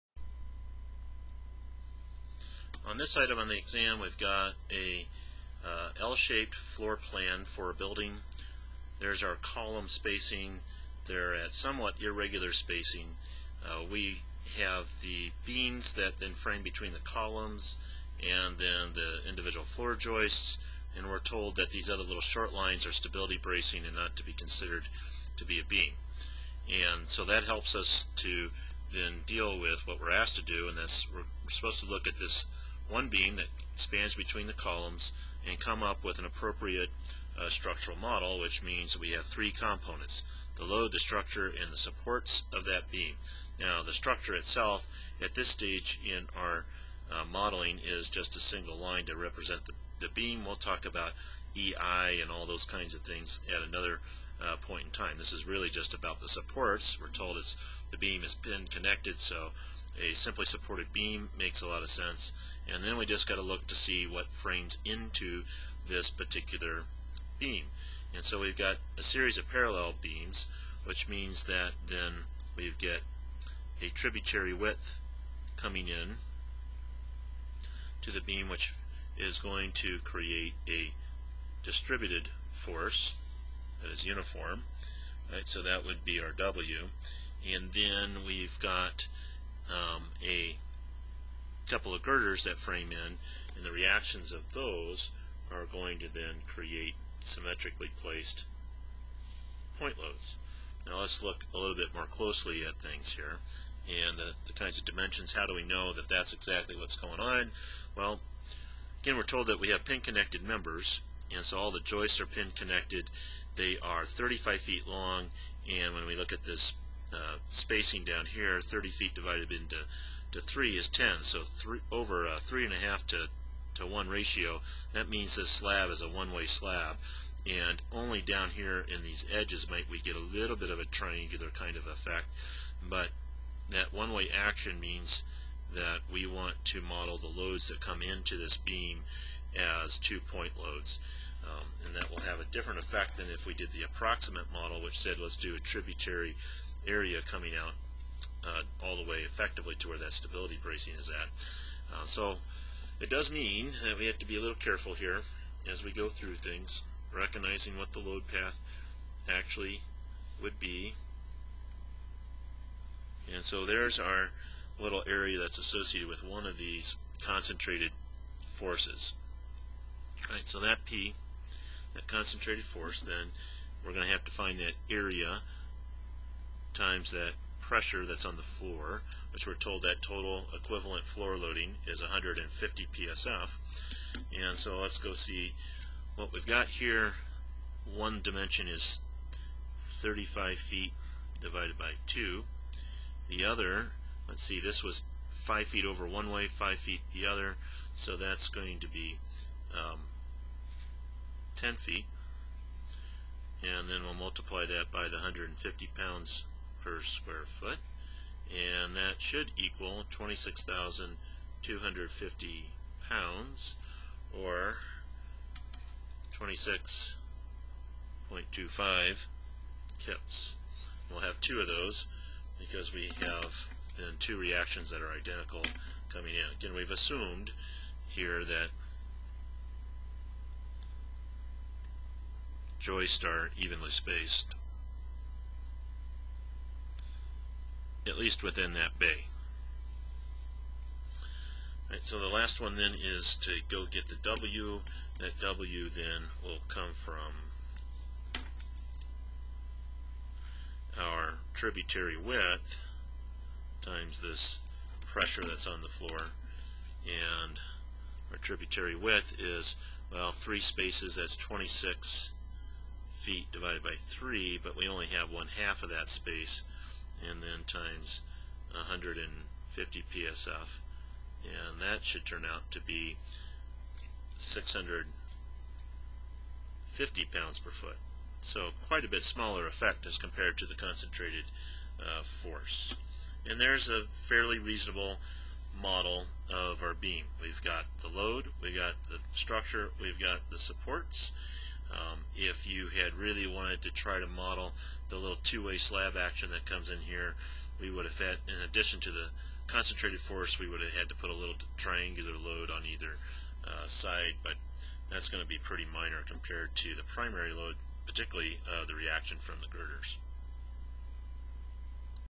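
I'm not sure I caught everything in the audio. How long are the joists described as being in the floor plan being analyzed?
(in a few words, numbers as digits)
35 feet.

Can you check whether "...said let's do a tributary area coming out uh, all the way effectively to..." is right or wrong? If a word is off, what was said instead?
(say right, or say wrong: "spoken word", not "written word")
right.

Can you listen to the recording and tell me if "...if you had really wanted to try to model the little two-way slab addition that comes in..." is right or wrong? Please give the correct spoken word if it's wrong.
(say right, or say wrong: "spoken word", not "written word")
wrong: "action", not "addition".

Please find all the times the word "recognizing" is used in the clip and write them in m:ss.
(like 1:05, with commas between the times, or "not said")
2:37.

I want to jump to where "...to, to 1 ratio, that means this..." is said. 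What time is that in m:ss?
2:03.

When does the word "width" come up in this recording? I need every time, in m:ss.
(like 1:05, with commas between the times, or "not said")
1:14, 4:12, 4:18.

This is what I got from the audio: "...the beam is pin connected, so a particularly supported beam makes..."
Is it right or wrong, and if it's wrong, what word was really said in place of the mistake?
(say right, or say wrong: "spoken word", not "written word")
wrong: "simply", not "particularly".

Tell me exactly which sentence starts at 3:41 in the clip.
We'll have two of those because we have then two reactions that are identical coming in.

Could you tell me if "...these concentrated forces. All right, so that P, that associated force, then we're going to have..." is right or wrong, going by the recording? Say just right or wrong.
wrong.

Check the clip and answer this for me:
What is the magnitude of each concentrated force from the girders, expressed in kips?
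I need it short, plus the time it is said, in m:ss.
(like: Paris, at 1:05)
26.25 kips, at 3:36.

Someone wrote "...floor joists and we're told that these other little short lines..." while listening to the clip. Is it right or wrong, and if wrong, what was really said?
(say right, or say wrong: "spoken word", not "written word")
right.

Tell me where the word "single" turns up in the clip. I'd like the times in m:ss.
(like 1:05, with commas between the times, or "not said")
0:48.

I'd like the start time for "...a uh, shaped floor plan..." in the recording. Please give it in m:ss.
0:04.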